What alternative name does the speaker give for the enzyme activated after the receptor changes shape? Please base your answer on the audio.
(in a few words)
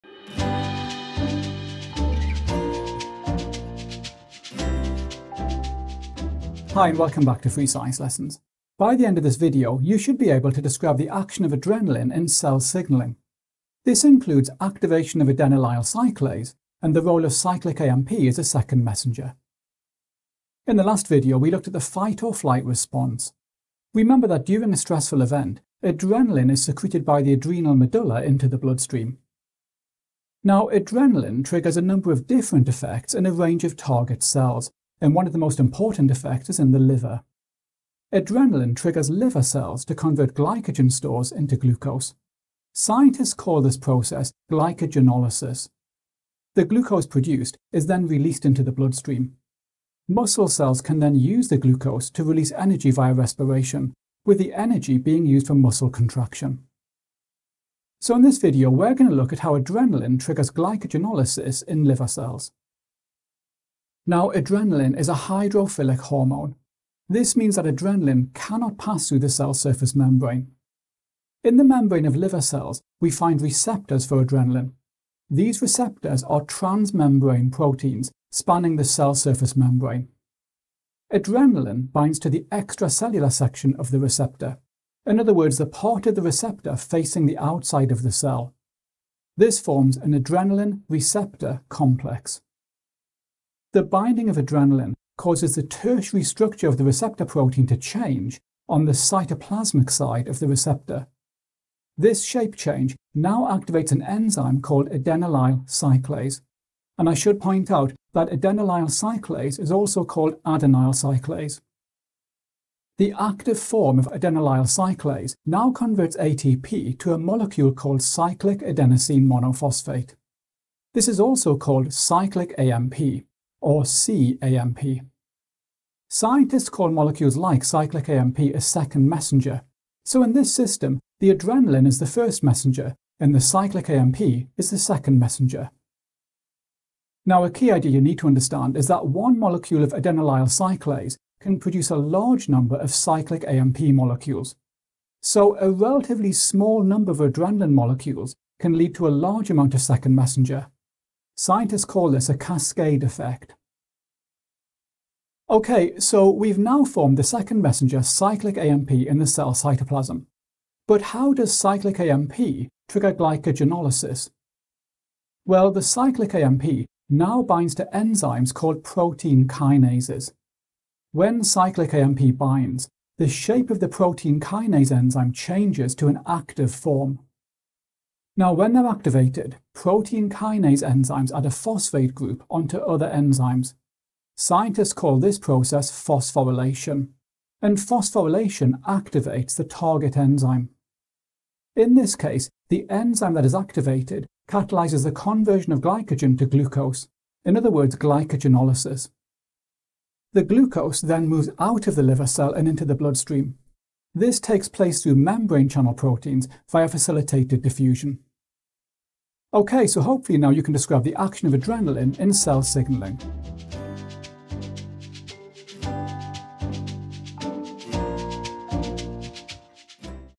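Adenyl cyclase.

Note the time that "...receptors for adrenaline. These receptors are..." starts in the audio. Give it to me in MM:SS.
01:13.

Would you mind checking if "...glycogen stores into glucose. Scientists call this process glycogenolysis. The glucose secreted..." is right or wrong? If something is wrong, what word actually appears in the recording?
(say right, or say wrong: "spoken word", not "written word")
wrong: "produced", not "secreted".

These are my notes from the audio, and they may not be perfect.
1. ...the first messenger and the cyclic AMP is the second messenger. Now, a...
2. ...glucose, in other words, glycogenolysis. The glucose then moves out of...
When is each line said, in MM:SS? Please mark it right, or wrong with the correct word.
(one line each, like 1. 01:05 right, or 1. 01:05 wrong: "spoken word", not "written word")
1. 02:11 right
2. 03:16 right.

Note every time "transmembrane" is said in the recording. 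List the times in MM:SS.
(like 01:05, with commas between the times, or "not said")
01:16.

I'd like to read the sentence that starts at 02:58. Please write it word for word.
Now, when they're activated, protein kinase enzymes add a phosphate group onto other enzymes.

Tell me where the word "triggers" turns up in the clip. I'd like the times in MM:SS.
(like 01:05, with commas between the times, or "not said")
00:31, 00:38, 01:00, 02:42.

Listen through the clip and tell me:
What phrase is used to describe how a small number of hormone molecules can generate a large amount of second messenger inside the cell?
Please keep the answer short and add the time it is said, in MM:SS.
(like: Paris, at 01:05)
Cascade effect, at 02:32.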